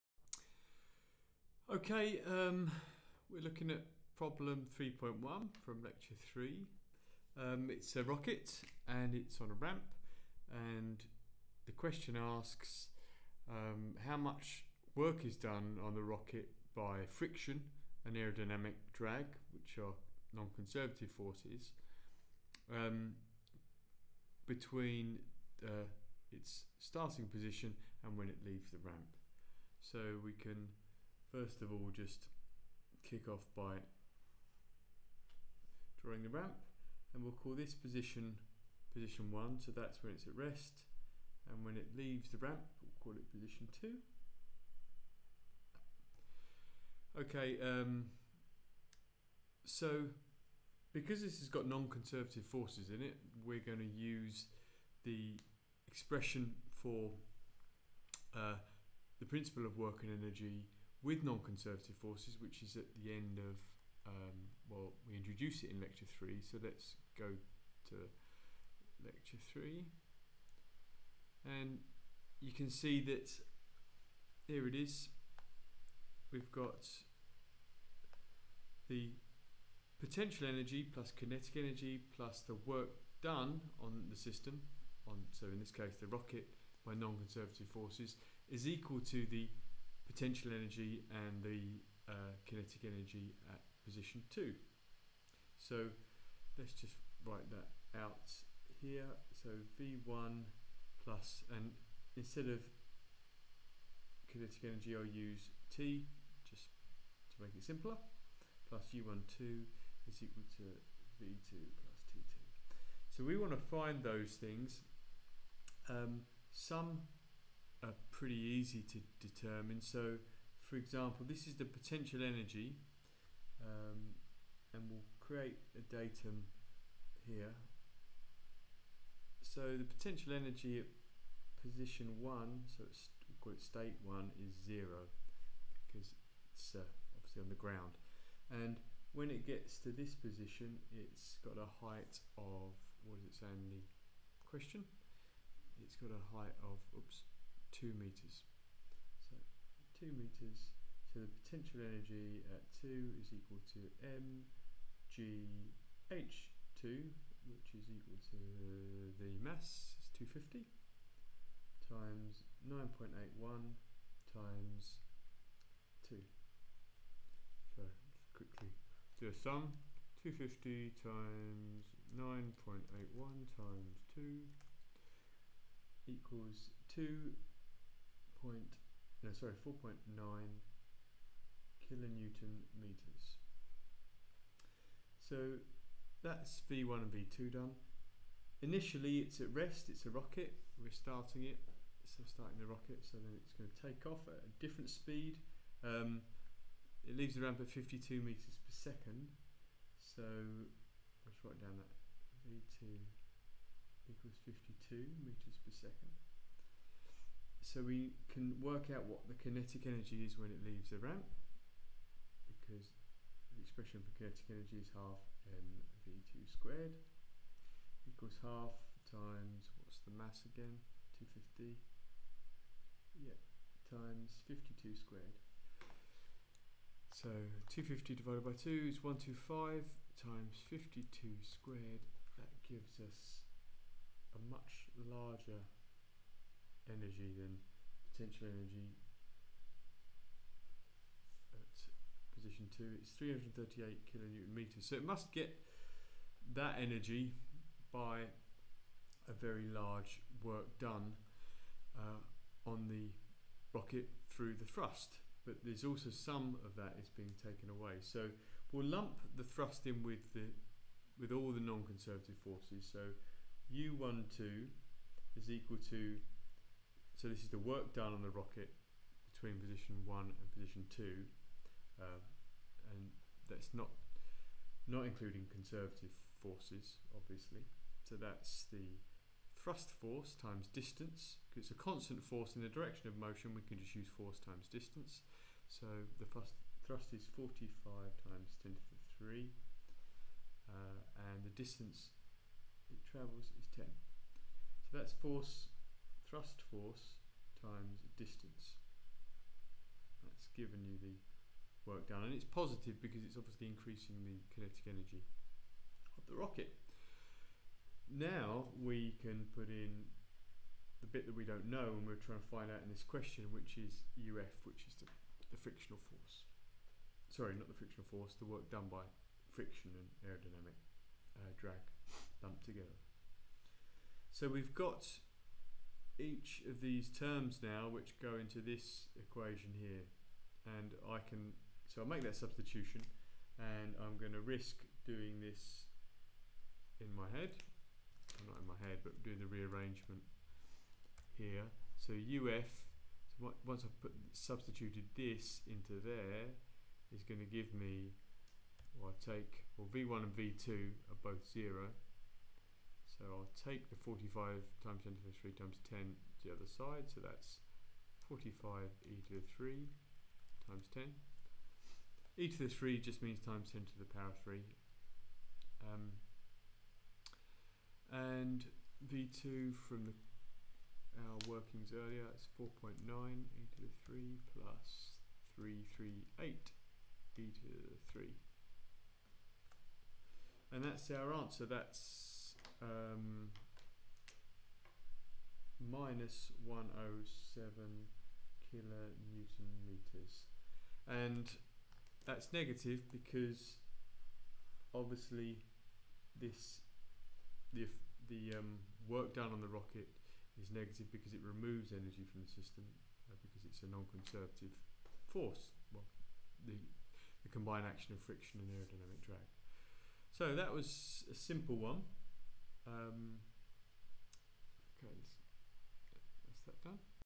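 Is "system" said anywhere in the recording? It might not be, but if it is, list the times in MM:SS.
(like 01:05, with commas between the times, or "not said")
01:24, 06:42.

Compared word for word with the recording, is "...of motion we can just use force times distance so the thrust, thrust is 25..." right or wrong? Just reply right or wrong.
wrong.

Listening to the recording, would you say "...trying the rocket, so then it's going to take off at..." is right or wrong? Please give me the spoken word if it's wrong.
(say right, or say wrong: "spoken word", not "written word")
wrong: "starting", not "trying".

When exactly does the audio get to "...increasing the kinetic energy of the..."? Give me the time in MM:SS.
05:03.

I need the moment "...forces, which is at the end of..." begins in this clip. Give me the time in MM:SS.
01:02.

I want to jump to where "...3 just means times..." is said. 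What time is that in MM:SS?
06:02.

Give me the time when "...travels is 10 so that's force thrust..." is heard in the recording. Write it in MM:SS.
04:53.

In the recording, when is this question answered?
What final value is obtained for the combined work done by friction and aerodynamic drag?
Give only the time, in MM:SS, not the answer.
06:25.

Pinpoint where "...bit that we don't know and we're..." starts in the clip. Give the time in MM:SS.
05:11.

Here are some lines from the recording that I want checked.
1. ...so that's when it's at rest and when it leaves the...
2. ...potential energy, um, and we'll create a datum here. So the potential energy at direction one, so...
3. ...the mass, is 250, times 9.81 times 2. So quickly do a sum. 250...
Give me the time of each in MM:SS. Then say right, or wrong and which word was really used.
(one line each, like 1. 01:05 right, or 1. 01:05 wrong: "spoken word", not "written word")
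1. 00:39 right
2. 02:01 wrong: "position", not "direction"
3. 02:39 right.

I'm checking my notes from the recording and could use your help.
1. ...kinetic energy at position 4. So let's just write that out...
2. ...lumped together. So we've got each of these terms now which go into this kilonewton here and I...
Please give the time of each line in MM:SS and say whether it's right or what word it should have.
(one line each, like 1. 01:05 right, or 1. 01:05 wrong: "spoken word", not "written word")
1. 01:32 wrong: "2", not "4"
2. 05:22 wrong: "equation", not "kilonewton".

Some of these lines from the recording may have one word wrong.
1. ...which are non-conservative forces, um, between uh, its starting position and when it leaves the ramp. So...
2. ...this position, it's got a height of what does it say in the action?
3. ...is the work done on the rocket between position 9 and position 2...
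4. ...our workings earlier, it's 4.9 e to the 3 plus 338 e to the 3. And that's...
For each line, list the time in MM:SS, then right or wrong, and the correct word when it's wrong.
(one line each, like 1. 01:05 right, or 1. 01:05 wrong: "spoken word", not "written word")
1. 00:19 right
2. 02:19 wrong: "question", not "action"
3. 04:27 wrong: "1", not "9"
4. 06:11 right.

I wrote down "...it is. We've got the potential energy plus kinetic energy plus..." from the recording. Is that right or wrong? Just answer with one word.
right.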